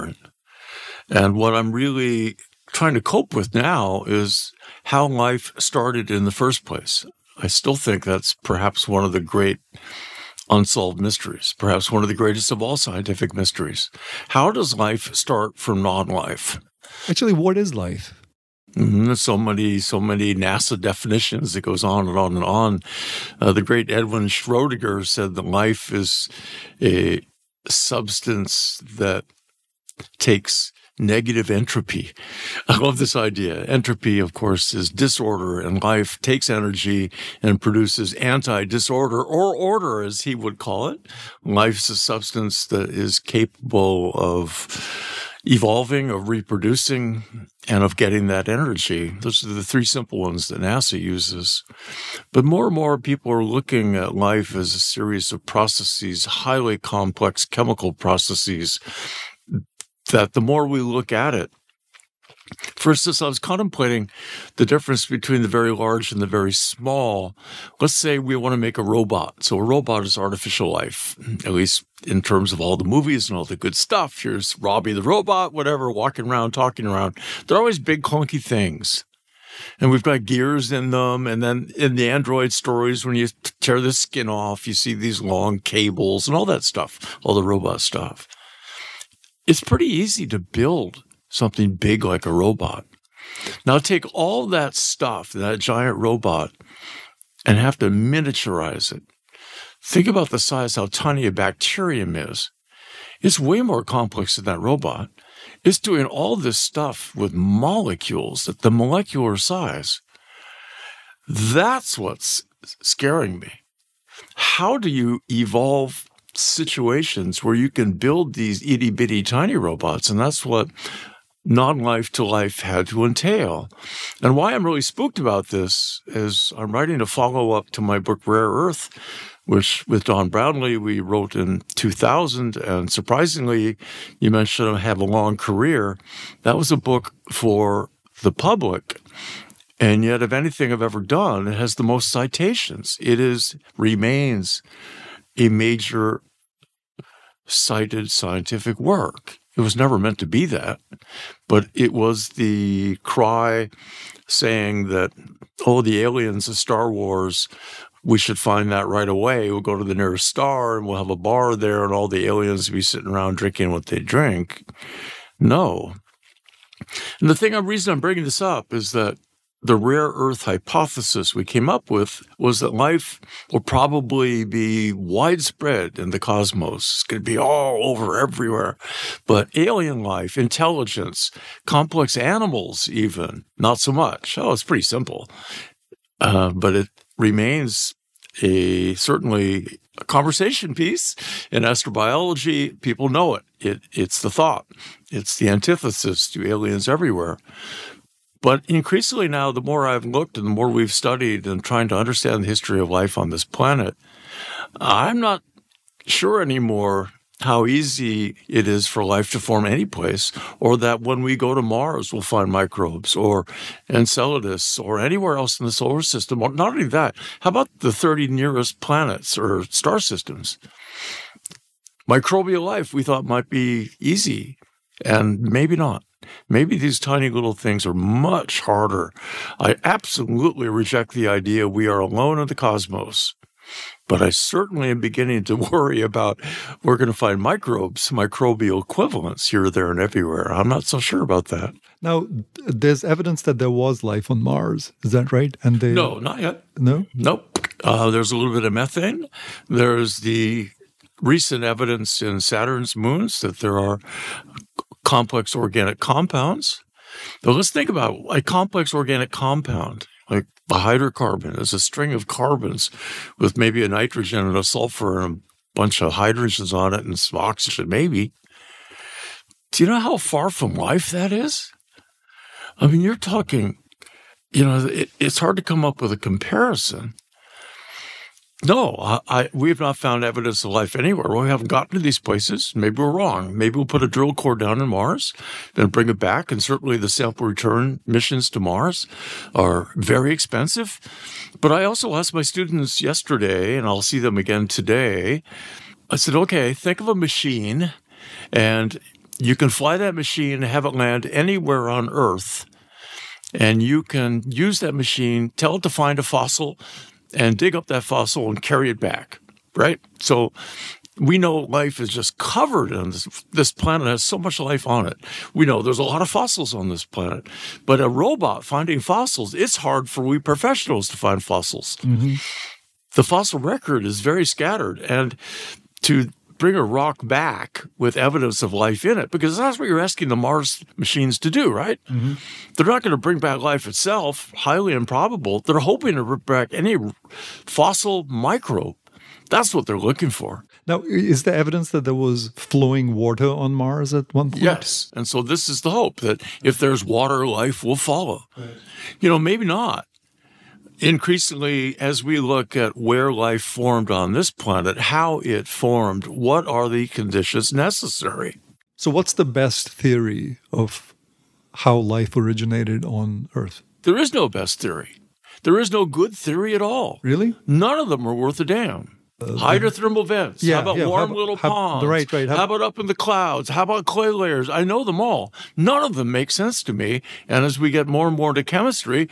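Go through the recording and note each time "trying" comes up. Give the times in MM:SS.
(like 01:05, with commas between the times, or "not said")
00:02, 03:21.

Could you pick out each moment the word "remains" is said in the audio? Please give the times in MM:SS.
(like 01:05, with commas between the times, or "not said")
02:23, 03:07.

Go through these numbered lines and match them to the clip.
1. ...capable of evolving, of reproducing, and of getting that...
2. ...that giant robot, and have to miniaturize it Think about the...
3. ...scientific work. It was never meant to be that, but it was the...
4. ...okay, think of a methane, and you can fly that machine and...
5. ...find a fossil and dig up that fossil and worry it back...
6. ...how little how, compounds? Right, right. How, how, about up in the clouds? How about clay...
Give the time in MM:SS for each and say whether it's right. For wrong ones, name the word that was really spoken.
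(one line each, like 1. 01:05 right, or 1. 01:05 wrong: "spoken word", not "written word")
1. 00:43 right
2. 01:35 right
3. 02:28 right
4. 04:56 wrong: "machine", not "methane"
5. 05:05 wrong: "carry", not "worry"
6. 06:11 wrong: "ponds", not "compounds".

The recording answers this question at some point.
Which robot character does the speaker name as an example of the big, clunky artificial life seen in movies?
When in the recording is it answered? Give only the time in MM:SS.
01:14.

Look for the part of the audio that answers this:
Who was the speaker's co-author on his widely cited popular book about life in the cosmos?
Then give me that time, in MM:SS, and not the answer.
02:10.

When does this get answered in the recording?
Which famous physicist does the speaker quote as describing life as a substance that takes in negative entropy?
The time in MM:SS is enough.
00:23.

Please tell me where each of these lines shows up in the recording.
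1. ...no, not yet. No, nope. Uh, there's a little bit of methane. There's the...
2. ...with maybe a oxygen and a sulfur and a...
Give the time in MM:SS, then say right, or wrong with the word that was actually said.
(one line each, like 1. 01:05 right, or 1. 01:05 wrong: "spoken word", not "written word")
1. 04:05 right
2. 04:23 wrong: "nitrogen", not "oxygen".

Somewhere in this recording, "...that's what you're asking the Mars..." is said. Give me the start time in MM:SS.
05:29.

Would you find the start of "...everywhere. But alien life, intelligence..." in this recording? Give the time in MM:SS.
02:58.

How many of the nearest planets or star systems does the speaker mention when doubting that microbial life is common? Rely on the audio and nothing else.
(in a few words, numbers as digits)
30.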